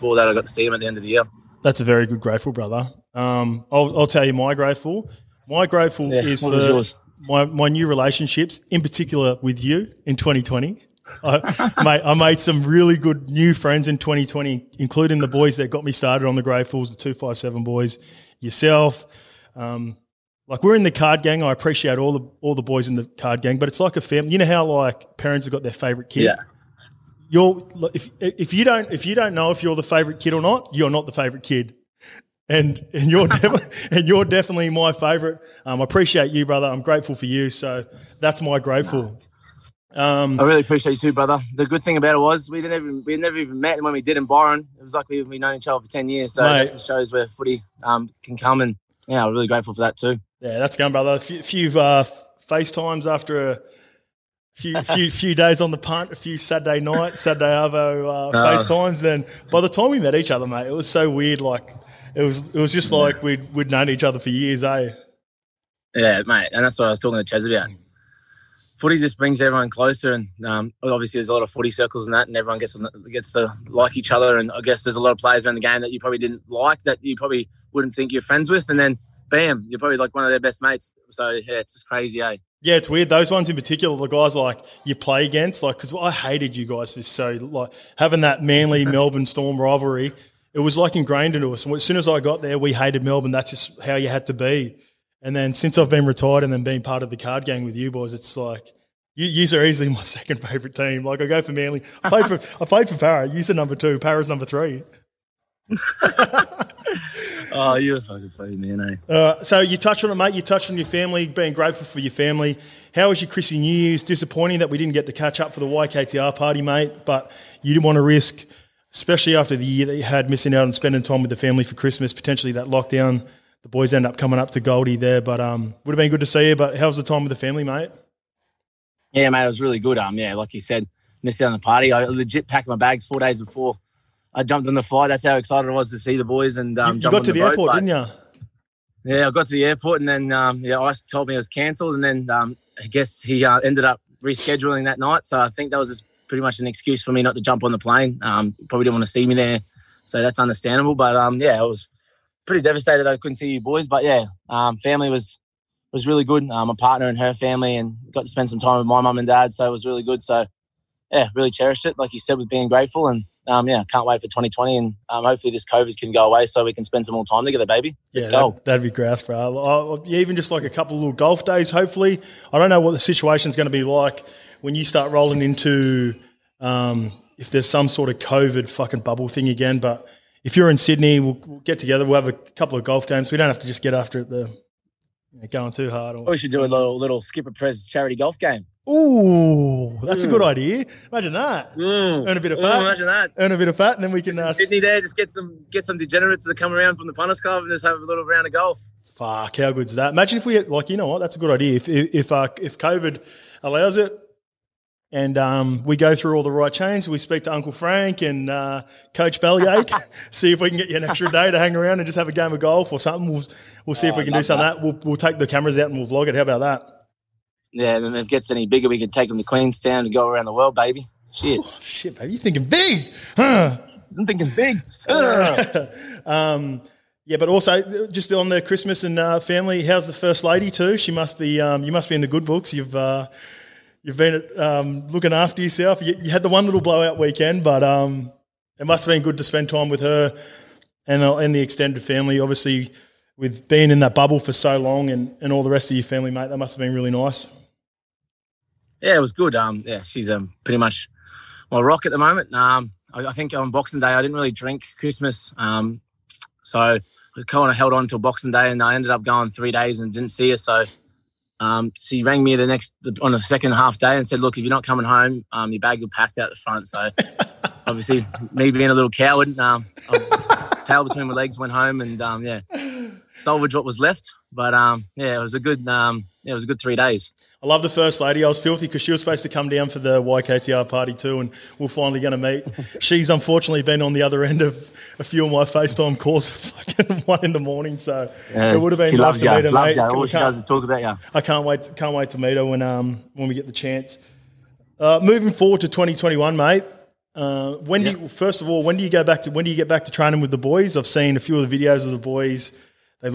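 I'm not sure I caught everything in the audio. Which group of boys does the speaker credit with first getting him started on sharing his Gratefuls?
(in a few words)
The 257 boys.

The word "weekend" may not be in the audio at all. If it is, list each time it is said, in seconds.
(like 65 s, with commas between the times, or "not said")
237 s.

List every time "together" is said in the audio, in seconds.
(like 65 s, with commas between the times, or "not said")
167 s, 181 s.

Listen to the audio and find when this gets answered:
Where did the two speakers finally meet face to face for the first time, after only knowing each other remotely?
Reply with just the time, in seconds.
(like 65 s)
44 s.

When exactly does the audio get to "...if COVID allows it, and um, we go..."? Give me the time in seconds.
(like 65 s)
202 s.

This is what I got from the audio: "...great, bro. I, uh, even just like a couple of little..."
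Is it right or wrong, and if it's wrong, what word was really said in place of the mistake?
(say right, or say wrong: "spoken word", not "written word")
right.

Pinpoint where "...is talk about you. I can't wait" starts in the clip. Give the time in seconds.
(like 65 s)
290 s.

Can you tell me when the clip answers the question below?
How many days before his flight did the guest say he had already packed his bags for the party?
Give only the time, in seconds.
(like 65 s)
133 s.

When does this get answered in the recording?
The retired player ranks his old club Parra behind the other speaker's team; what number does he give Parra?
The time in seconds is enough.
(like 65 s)
104 s.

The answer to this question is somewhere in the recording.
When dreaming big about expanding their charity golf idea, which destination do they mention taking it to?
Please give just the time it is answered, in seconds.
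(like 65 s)
219 s.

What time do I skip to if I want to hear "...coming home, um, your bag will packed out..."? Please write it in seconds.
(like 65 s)
264 s.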